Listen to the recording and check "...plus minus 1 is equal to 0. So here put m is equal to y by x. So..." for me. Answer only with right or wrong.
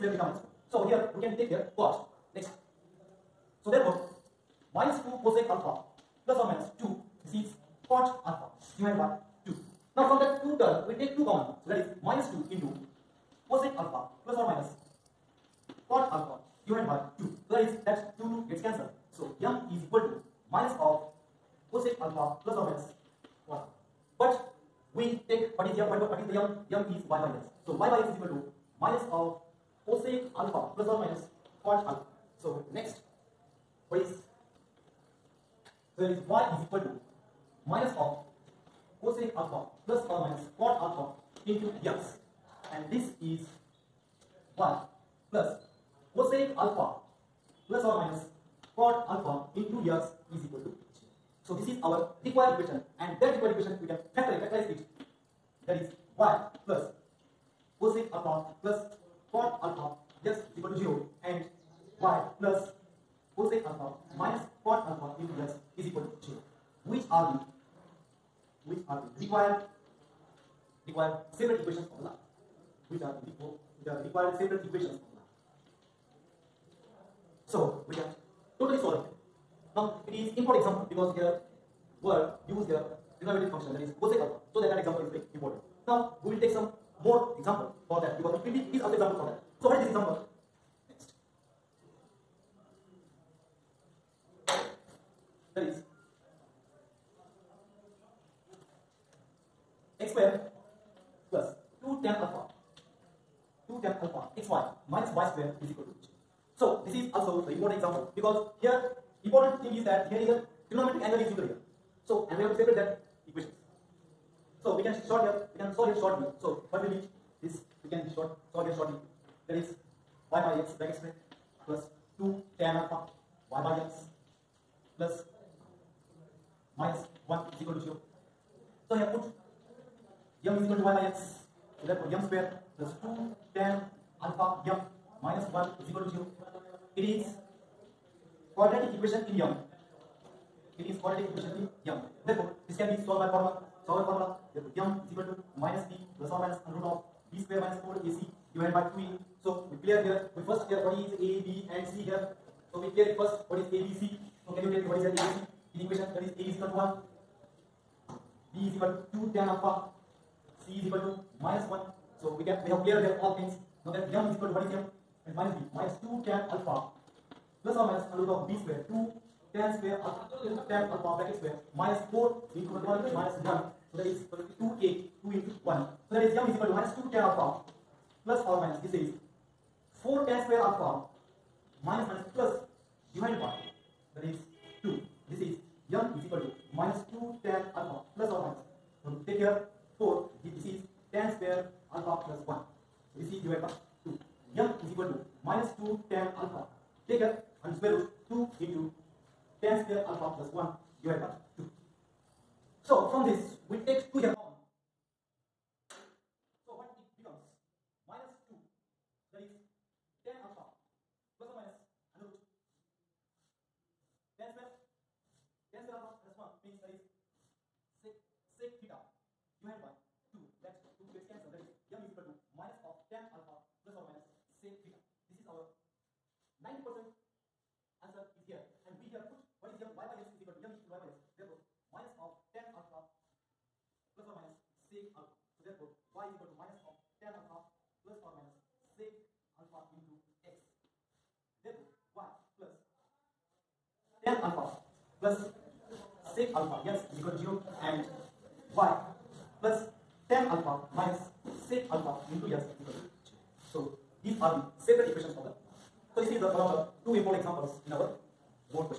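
right.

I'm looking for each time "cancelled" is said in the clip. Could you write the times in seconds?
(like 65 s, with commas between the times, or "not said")
18 s, 221 s.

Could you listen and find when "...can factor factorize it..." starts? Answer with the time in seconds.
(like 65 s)
53 s.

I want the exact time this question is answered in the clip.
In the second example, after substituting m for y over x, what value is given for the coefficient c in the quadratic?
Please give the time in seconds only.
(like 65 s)
160 s.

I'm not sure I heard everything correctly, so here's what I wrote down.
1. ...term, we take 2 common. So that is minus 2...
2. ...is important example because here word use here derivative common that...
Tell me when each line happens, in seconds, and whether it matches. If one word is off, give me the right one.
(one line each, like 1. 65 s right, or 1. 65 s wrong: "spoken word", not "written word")
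1. 10 s right
2. 80 s wrong: "function", not "common".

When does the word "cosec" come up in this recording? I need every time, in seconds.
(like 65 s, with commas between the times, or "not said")
5 s, 13 s, 21 s, 29 s, 46 s, 57 s, 63 s, 84 s.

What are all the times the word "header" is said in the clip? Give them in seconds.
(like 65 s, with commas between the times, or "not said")
not said.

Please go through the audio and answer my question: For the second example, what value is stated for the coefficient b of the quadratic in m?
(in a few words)
2 tan alpha.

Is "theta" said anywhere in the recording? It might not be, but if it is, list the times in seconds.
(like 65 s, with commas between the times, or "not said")
0 s, 218 s, 224 s.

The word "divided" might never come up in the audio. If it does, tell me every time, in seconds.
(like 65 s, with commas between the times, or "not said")
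16 s, 148 s, 183 s, 193 s, 201 s.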